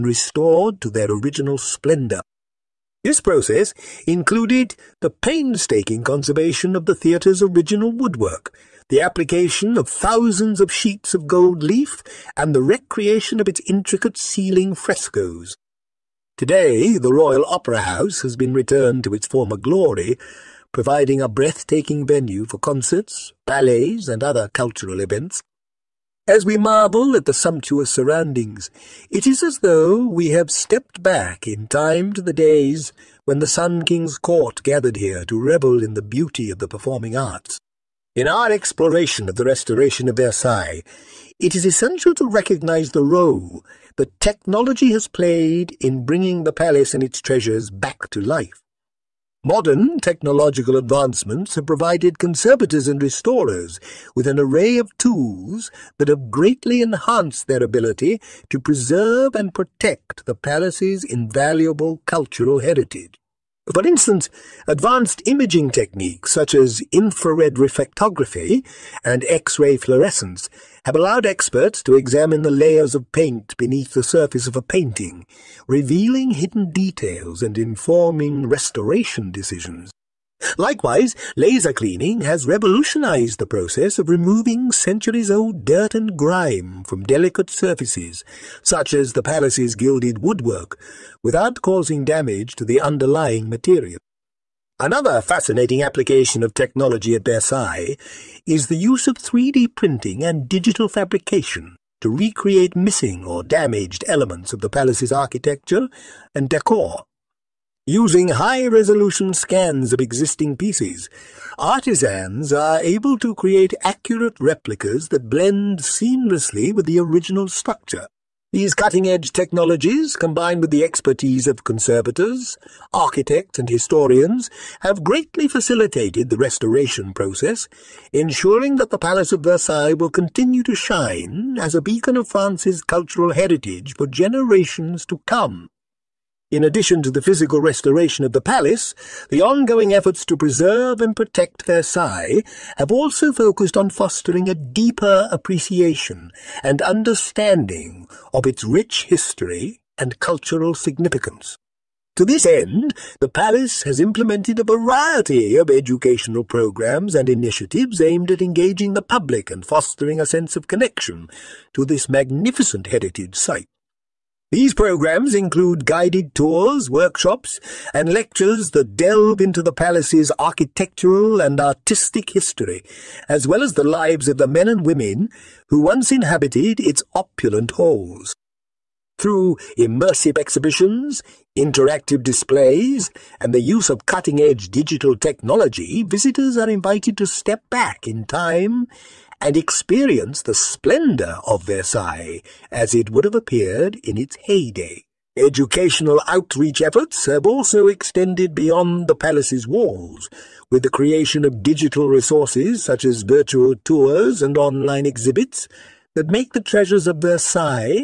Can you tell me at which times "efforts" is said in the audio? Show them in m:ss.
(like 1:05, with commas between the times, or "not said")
2:19, 3:16.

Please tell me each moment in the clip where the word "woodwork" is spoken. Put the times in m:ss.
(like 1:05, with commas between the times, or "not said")
0:07, 1:30.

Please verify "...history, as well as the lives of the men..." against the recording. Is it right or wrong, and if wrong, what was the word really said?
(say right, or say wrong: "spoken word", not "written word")
right.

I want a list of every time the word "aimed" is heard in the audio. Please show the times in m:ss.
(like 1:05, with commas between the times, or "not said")
2:37.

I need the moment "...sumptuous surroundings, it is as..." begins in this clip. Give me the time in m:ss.
0:27.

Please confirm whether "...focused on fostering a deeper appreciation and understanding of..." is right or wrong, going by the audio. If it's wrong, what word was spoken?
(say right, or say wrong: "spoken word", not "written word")
right.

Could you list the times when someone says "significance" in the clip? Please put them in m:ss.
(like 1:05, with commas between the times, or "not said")
2:30.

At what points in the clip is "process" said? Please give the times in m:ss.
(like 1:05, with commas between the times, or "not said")
0:03, 1:23, 2:07.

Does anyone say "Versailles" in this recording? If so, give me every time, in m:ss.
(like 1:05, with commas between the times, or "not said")
0:40, 1:37, 2:09, 2:21, 3:11, 3:27.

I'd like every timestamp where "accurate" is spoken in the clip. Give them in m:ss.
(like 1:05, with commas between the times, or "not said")
1:53.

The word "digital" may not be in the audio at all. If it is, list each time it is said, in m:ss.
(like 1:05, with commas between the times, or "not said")
1:40, 3:04, 3:21.